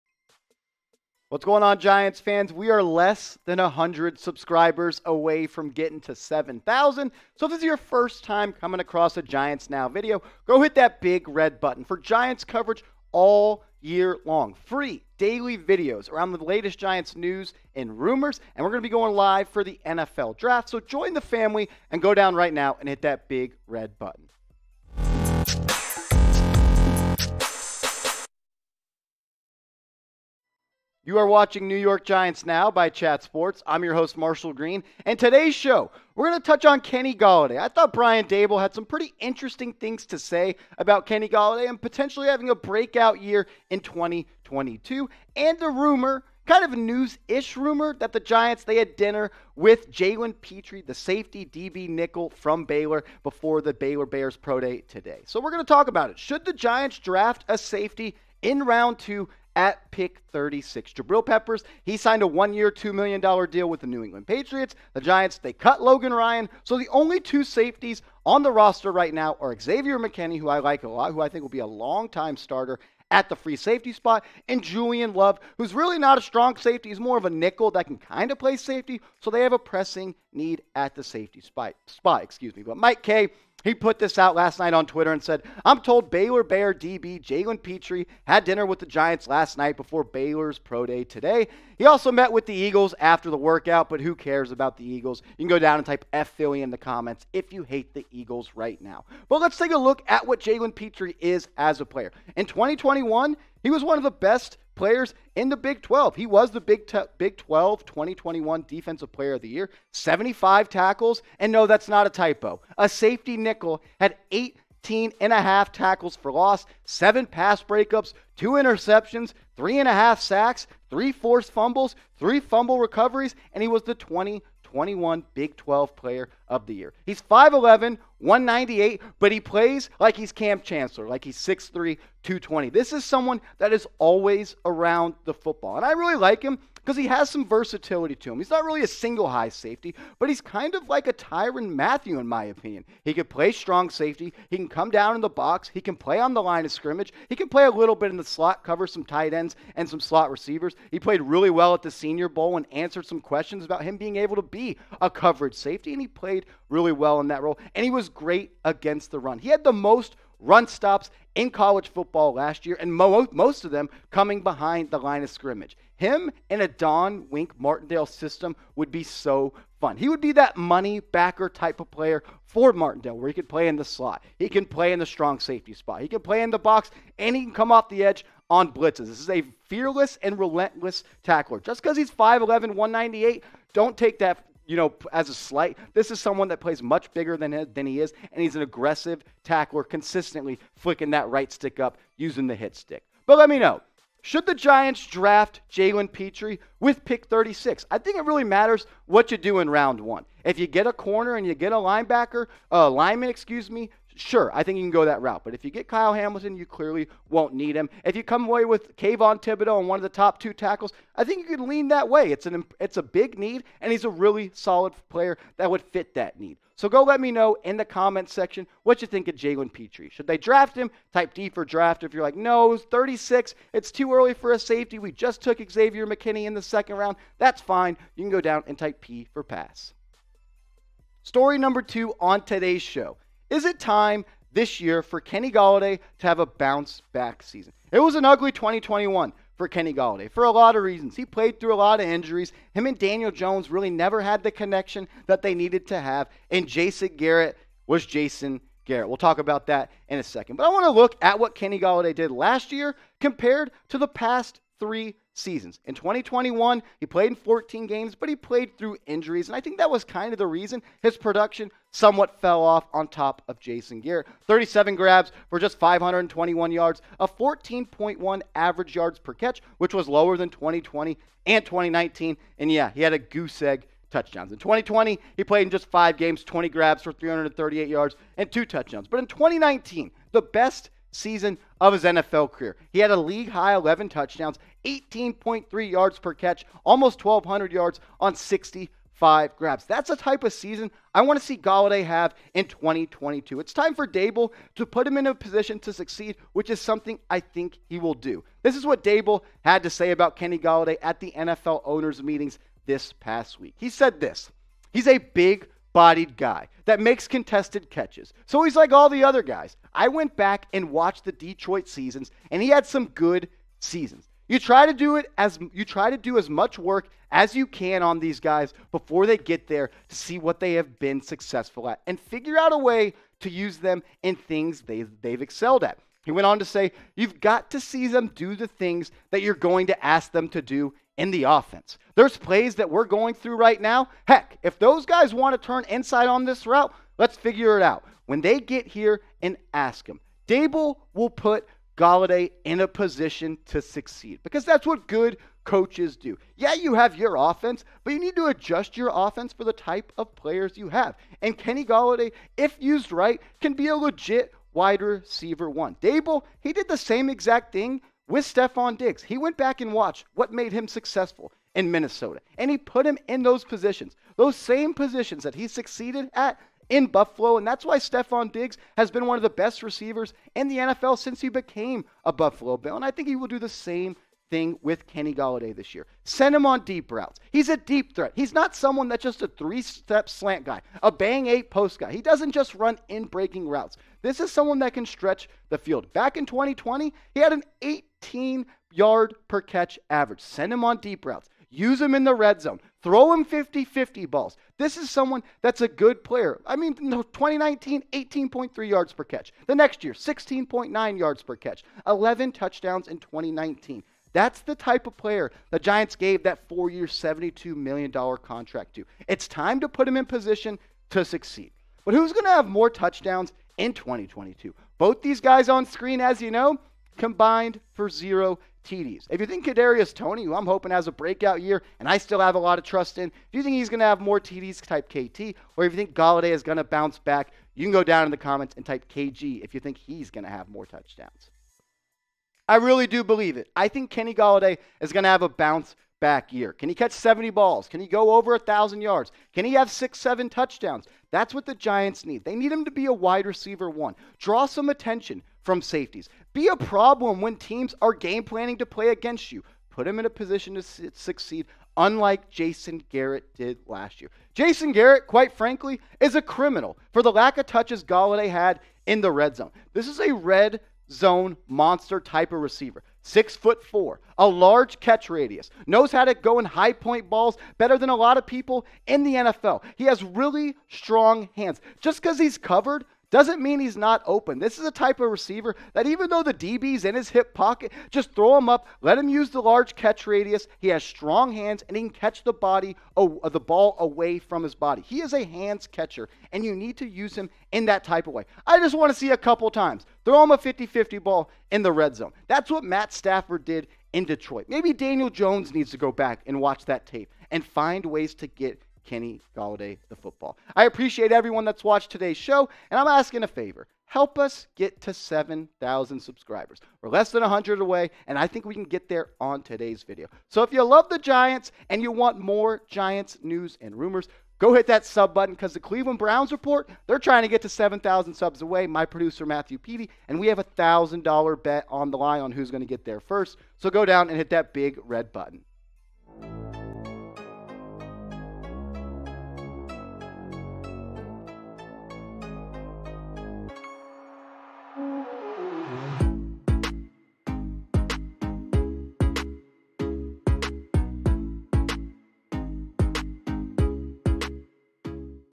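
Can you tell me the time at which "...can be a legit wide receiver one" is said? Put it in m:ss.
5:53.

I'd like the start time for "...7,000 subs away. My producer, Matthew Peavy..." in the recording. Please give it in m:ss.
8:37.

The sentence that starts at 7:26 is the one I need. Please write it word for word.
Be a problem when teams are game planning to play against you.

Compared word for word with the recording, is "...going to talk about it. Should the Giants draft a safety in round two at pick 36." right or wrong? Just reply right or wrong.
right.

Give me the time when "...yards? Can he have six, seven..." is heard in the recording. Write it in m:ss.
7:19.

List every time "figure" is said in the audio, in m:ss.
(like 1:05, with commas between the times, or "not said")
5:22, 5:37.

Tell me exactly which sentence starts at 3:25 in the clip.
But if you get Kyle Hamilton, you clearly won't need him.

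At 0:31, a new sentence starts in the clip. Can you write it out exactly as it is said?
You are watching New York Giants Now by Chat Sports.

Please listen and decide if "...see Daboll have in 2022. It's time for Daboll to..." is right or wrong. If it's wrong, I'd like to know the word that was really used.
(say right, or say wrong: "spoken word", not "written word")
wrong: "Golladay", not "Daboll".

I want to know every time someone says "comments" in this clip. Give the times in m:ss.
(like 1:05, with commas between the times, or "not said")
1:36, 3:37, 7:08.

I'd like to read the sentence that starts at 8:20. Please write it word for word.
I appreciate everyone that's watched today's show, and I'm asking a favor.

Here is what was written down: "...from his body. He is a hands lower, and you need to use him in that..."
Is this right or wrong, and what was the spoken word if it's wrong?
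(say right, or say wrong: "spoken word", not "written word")
wrong: "catcher", not "lower".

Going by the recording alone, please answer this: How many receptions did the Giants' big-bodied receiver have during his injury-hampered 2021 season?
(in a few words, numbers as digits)
37.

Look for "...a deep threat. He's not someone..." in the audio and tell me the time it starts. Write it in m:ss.
6:17.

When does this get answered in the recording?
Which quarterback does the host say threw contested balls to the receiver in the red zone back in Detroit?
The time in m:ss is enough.
8:12.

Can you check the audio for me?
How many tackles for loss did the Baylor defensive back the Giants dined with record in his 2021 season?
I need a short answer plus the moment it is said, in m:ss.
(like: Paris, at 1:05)
18.5, at 1:54.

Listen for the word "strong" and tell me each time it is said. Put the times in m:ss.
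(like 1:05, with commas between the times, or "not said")
1:16, 2:23, 2:55, 7:50, 8:01.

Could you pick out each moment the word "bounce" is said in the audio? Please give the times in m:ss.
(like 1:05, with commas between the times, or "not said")
3:56, 7:06, 7:15.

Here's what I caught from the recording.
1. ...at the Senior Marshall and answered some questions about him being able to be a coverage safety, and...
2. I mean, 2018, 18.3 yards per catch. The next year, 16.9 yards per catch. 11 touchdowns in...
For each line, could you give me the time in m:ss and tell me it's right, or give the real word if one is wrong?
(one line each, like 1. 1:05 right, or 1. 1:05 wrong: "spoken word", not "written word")
1. 2:31 wrong: "Bowl", not "Marshall"
2. 6:36 wrong: "2019", not "2018".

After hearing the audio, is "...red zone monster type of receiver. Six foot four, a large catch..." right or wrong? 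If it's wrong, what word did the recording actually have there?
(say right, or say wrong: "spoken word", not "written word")
right.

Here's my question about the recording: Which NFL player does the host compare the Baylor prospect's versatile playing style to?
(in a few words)
Tyrann Mathieu.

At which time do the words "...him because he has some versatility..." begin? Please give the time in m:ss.
2:16.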